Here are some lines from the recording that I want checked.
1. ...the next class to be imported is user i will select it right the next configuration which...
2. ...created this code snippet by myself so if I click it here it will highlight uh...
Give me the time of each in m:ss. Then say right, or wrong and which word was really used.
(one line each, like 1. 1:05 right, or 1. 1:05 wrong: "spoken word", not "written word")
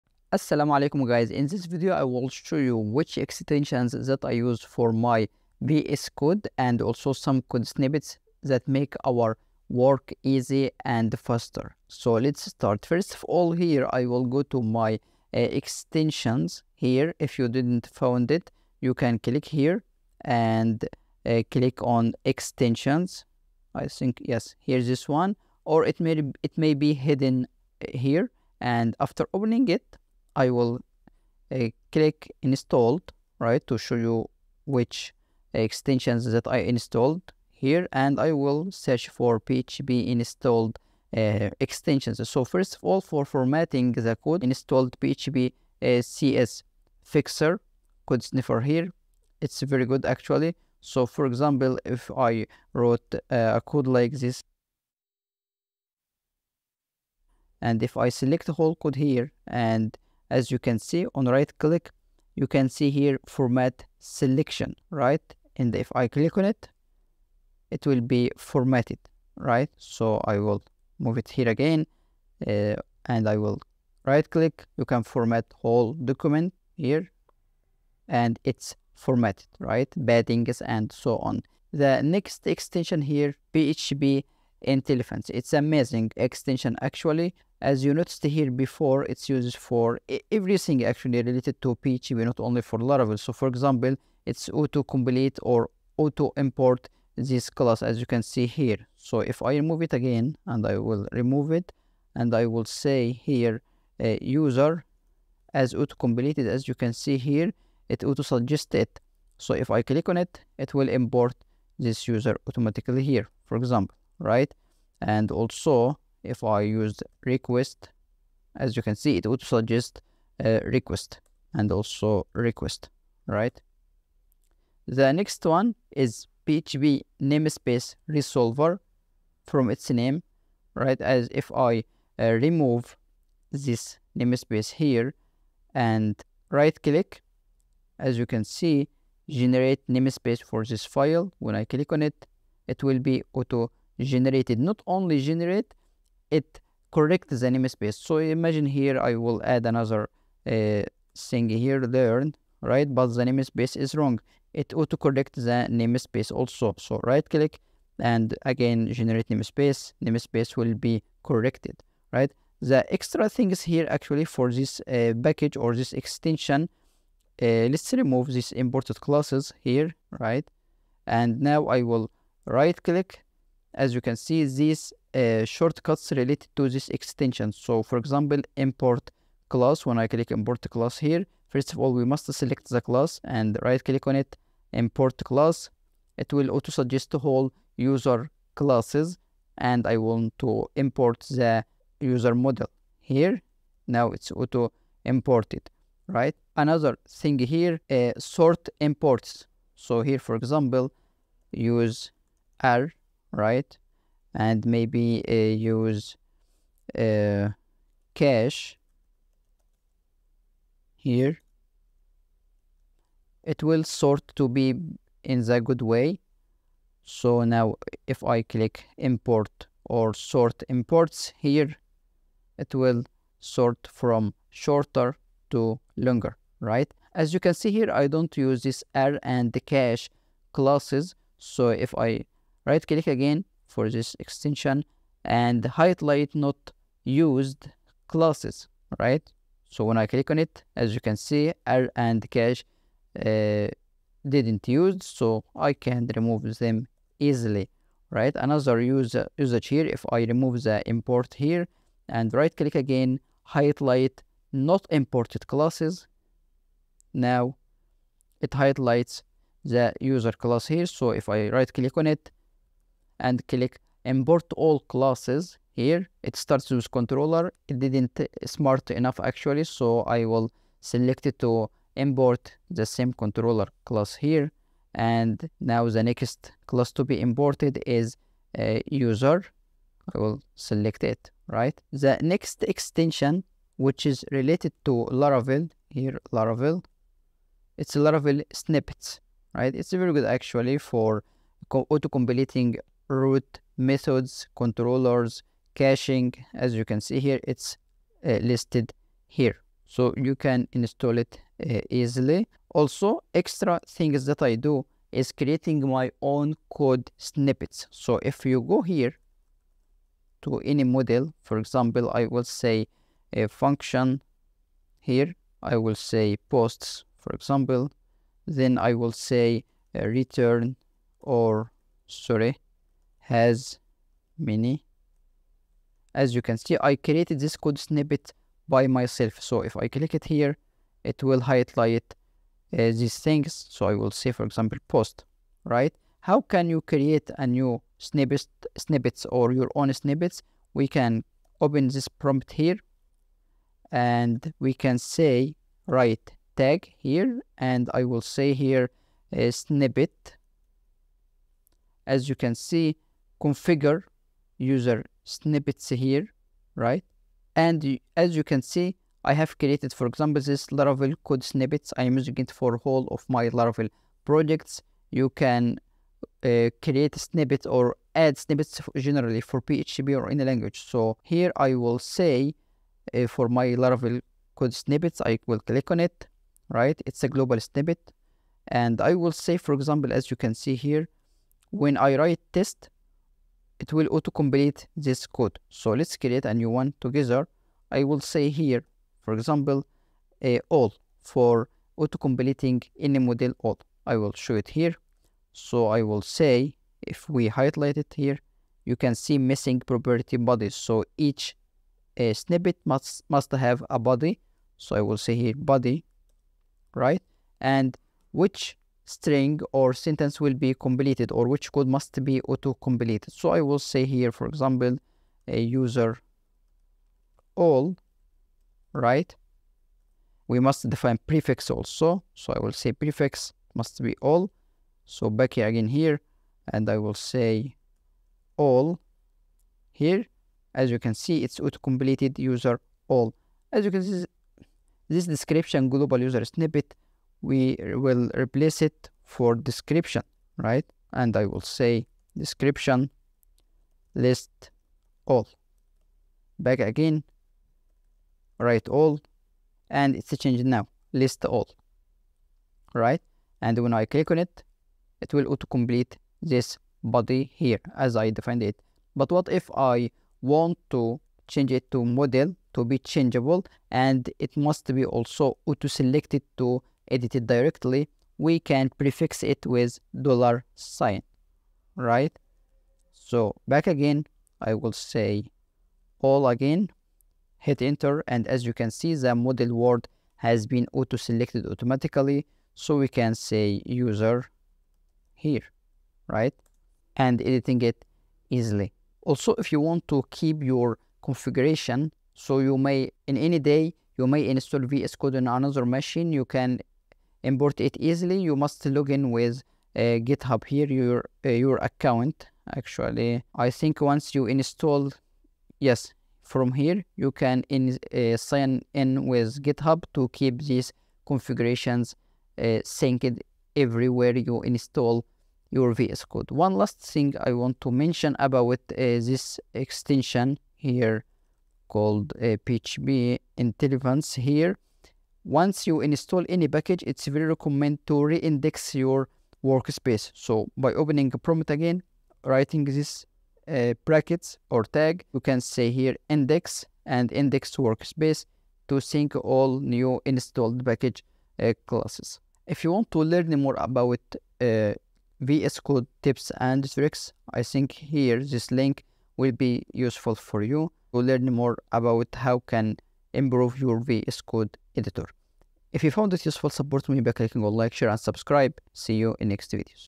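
1. 4:35 wrong: "extension", not "configuration"
2. 5:26 right.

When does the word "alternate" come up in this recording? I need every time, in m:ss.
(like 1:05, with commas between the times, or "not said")
not said.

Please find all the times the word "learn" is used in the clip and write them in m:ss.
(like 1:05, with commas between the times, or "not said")
2:31, 9:03, 9:11.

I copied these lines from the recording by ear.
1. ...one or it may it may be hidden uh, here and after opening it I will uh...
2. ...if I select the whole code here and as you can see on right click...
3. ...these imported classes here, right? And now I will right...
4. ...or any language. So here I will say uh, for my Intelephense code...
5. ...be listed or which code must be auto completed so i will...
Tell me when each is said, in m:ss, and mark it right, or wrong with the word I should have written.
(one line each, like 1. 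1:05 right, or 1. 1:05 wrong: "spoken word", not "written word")
1. 0:25 right
2. 0:57 right
3. 2:48 right
4. 6:10 wrong: "Laravel", not "Intelephense"
5. 6:50 wrong: "completed", not "listed".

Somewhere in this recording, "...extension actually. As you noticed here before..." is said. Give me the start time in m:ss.
1:26.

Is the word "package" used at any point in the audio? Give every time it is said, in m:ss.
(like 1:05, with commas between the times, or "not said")
2:45, 8:46, 9:00.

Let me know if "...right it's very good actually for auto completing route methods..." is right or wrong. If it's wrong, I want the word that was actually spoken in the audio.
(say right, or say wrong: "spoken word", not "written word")
right.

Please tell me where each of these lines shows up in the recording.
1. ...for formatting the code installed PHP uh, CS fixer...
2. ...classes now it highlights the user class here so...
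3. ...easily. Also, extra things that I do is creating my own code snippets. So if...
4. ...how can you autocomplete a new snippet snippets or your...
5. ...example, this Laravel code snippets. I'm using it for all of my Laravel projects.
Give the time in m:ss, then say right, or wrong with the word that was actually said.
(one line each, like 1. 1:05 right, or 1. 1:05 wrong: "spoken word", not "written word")
1. 0:43 right
2. 4:15 right
3. 5:01 right
4. 5:36 wrong: "create", not "autocomplete"
5. 6:00 right.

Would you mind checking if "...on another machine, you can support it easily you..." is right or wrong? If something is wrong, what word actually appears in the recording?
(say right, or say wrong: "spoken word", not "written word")
wrong: "import", not "support".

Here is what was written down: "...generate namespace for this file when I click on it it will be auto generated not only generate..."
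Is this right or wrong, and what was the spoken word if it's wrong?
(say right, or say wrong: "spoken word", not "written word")
right.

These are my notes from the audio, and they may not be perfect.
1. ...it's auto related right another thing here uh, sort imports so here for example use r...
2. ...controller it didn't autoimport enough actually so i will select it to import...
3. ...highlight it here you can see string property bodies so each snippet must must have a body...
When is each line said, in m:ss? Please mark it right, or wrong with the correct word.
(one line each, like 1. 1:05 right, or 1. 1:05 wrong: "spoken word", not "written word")
1. 3:14 wrong: "imported", not "related"
2. 4:26 wrong: "smart", not "autoimport"
3. 6:37 wrong: "missing", not "string".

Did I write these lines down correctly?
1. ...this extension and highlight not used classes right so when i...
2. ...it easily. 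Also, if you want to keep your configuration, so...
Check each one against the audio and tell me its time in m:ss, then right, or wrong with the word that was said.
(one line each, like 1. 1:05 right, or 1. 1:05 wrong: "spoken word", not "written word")
1. 3:53 right
2. 8:07 right.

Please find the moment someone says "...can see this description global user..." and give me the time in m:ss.
7:13.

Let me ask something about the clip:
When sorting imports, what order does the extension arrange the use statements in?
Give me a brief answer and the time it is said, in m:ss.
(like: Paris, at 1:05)
shorter to longer, at 3:44.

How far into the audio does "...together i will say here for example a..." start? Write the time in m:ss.
6:27.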